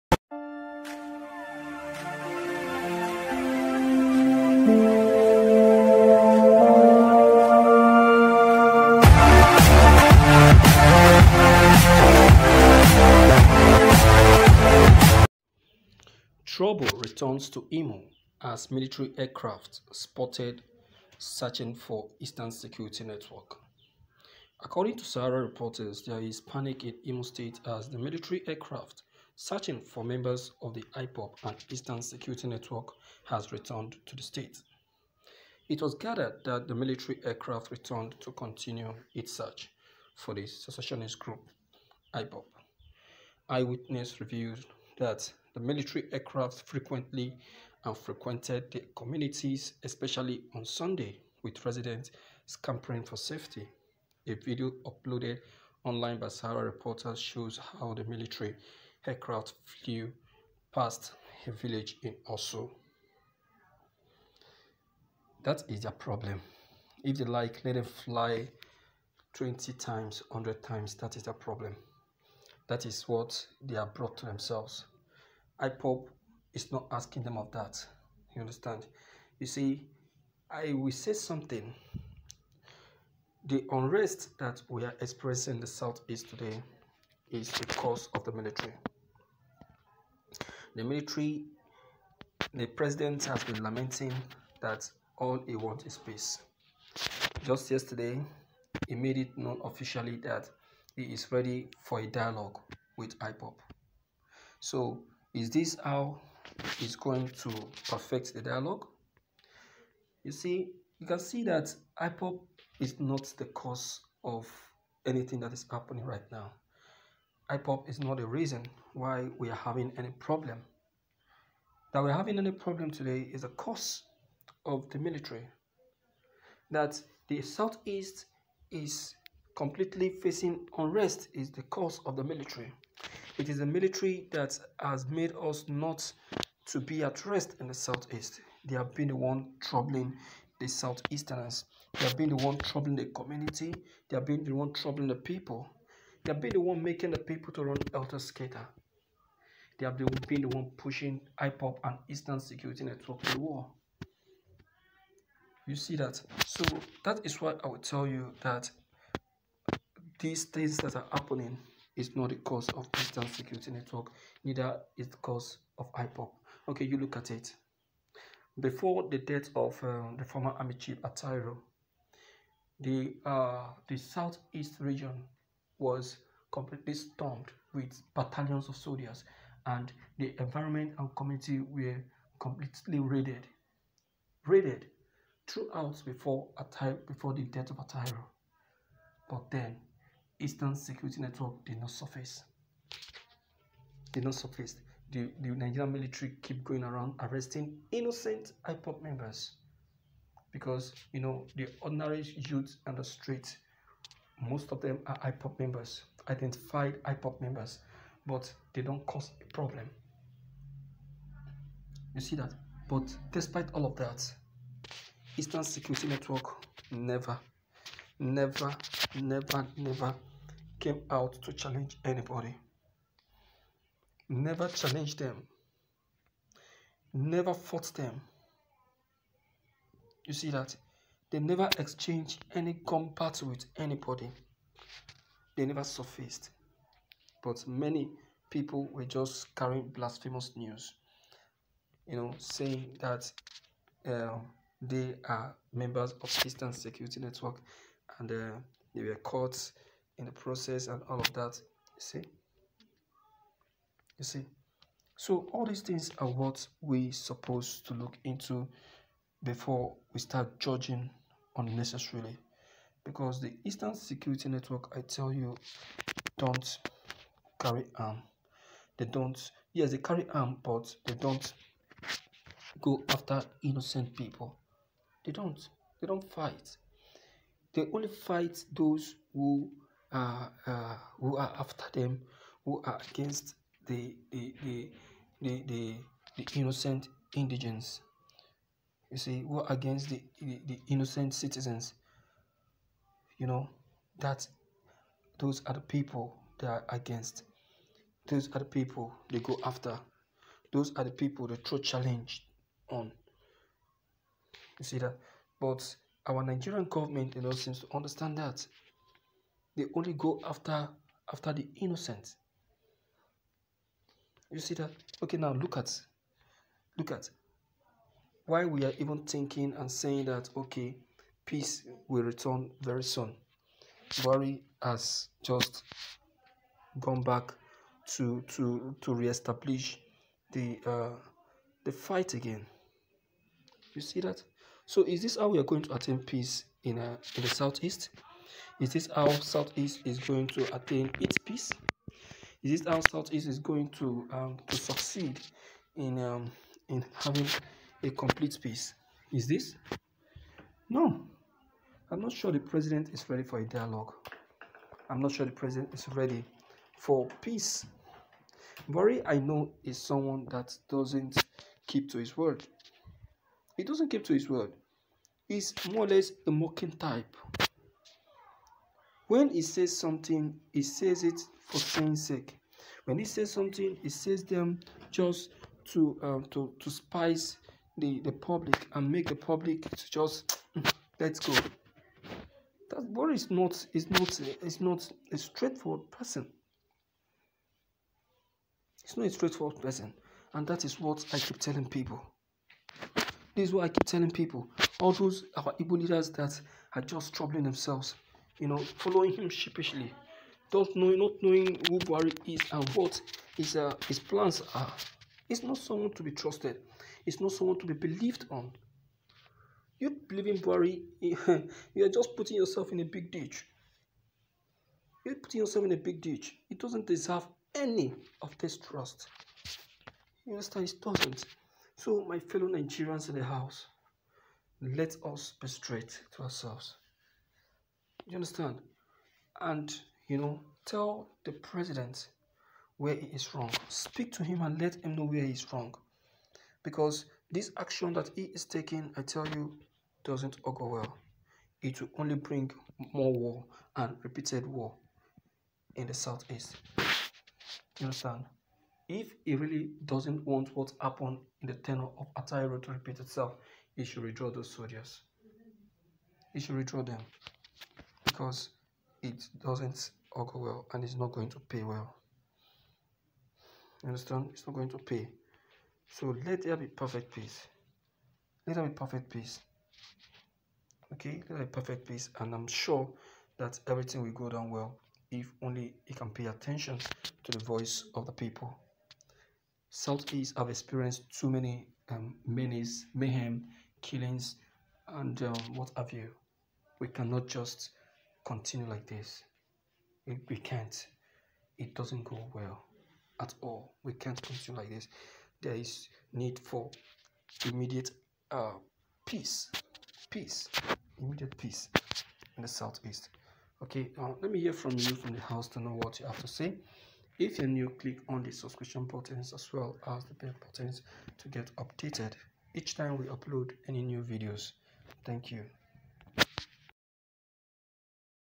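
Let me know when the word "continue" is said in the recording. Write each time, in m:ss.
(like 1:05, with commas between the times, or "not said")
0:38, 8:08, 8:14.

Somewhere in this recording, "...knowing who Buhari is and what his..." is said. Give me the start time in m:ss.
6:41.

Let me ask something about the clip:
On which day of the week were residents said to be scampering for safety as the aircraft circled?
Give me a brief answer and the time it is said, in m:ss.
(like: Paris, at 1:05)
Sunday, at 0:50.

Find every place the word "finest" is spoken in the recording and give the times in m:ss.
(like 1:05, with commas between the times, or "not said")
not said.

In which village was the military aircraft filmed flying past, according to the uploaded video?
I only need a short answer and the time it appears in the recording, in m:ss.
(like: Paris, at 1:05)
Osu, at 1:02.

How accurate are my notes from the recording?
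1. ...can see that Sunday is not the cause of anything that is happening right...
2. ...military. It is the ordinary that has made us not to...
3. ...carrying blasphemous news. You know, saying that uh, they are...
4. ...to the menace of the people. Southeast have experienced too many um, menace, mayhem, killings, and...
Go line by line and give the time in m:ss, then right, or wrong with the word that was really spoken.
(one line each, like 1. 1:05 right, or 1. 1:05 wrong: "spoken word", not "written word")
1. 1:51 wrong: "IPOB", not "Sunday"
2. 2:12 wrong: "military", not "ordinary"
3. 3:59 right
4. 7:57 wrong: "voice", not "menace".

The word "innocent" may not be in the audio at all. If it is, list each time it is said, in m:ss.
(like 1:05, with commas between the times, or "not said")
3:17, 4:33, 4:46, 4:50, 5:11.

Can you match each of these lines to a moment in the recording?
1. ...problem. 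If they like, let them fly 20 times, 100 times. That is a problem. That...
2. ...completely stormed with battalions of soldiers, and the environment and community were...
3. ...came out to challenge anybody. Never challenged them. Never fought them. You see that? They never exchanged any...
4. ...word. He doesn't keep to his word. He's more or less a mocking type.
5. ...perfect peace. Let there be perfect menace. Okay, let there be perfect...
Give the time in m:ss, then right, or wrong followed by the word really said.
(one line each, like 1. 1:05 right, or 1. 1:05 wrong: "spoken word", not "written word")
1. 1:05 right
2. 2:56 right
3. 3:40 right
4. 6:02 right
5. 7:46 wrong: "peace", not "menace".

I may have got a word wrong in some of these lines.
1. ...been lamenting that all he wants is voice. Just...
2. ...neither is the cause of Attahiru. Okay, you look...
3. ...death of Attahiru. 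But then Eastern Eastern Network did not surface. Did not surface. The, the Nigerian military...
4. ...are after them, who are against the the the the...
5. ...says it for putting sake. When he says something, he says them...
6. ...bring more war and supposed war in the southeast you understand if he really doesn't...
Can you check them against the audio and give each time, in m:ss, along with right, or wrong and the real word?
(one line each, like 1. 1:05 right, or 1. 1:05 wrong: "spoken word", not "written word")
1. 1:33 wrong: "peace", not "voice"
2. 2:44 wrong: "IPOB", not "Attahiru"
3. 3:07 wrong: "Security", not "Eastern"
4. 4:41 right
5. 6:10 wrong: "saying", not "putting"
6. 7:22 wrong: "repeated", not "supposed".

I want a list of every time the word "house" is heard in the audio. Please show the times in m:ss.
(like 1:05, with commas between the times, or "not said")
7:03, 8:25.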